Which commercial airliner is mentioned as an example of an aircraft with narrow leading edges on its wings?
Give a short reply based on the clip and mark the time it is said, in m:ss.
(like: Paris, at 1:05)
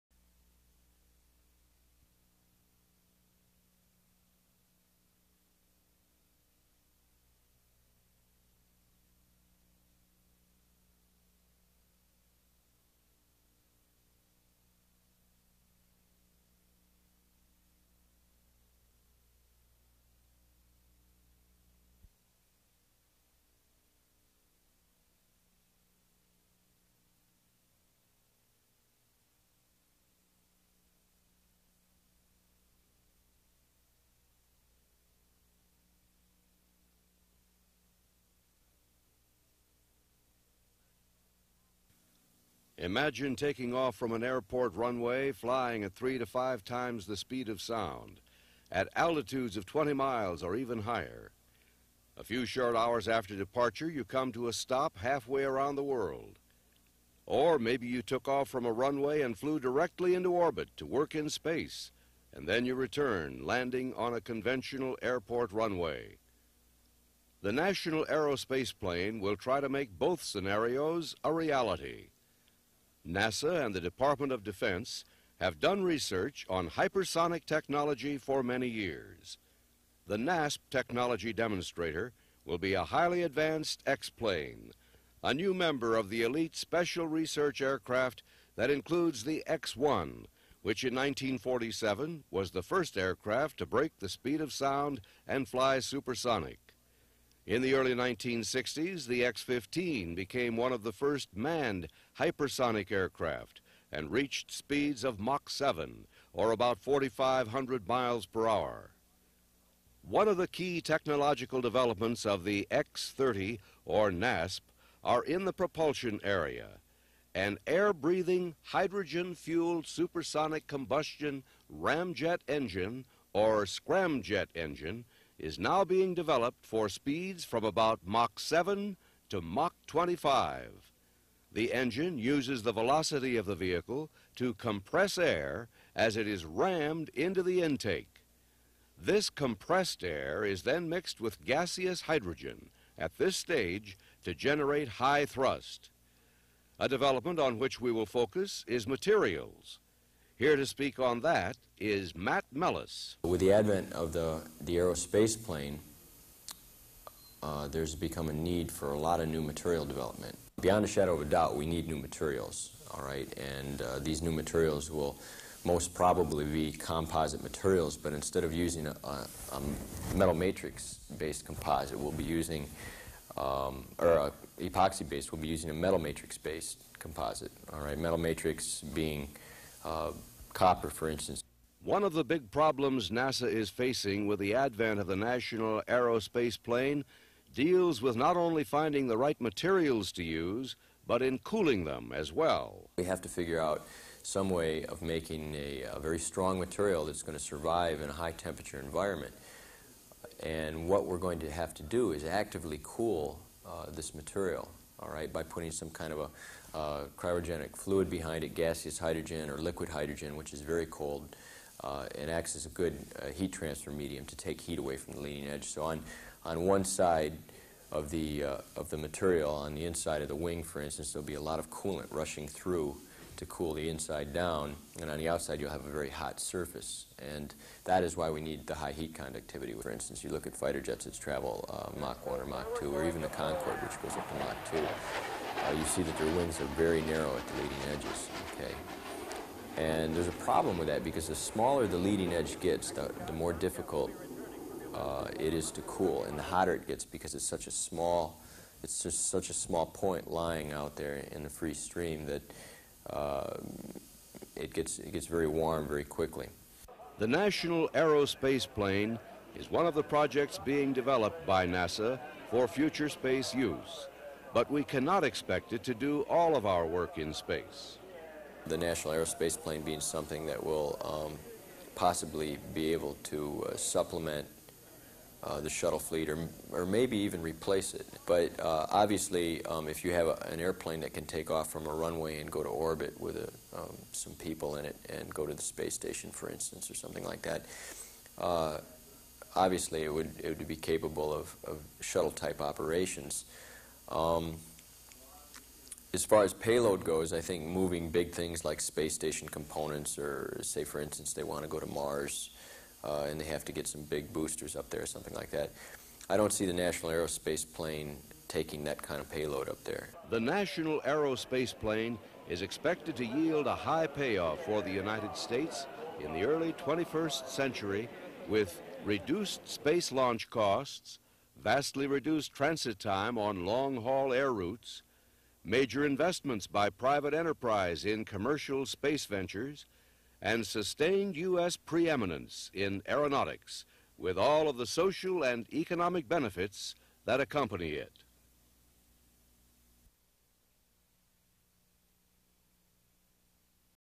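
Concorde, at 3:53.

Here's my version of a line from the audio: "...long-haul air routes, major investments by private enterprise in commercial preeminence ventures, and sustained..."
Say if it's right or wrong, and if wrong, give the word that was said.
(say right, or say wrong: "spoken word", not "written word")
wrong: "space", not "preeminence".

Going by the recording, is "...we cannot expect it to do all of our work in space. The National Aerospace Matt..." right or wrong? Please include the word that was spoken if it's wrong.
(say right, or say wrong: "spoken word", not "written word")
wrong: "Plane", not "Matt".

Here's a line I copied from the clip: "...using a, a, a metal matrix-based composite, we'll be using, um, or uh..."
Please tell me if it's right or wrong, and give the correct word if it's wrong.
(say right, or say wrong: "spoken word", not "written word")
right.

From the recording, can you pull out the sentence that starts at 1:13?
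NASA and the Department of Defense have done research on hypersonic technology for many years.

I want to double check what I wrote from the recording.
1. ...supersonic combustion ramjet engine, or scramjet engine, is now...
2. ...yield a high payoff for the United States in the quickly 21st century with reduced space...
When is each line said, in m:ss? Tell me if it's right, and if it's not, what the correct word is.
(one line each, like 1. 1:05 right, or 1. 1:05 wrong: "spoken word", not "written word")
1. 1:59 right
2. 5:13 wrong: "early", not "quickly".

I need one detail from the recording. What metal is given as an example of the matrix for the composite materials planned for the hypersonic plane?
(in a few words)
copper.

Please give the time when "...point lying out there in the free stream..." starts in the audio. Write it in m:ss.
4:09.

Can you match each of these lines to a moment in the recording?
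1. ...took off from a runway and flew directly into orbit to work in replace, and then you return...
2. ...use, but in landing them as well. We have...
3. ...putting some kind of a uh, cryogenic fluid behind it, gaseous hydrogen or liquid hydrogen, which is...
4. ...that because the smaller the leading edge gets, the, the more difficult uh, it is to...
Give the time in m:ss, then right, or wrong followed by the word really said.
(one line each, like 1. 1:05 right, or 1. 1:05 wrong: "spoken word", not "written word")
1. 0:58 wrong: "space", not "replace"
2. 3:10 wrong: "cooling", not "landing"
3. 3:25 right
4. 4:00 right.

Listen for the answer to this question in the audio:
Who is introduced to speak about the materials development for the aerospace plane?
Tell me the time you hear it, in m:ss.
2:32.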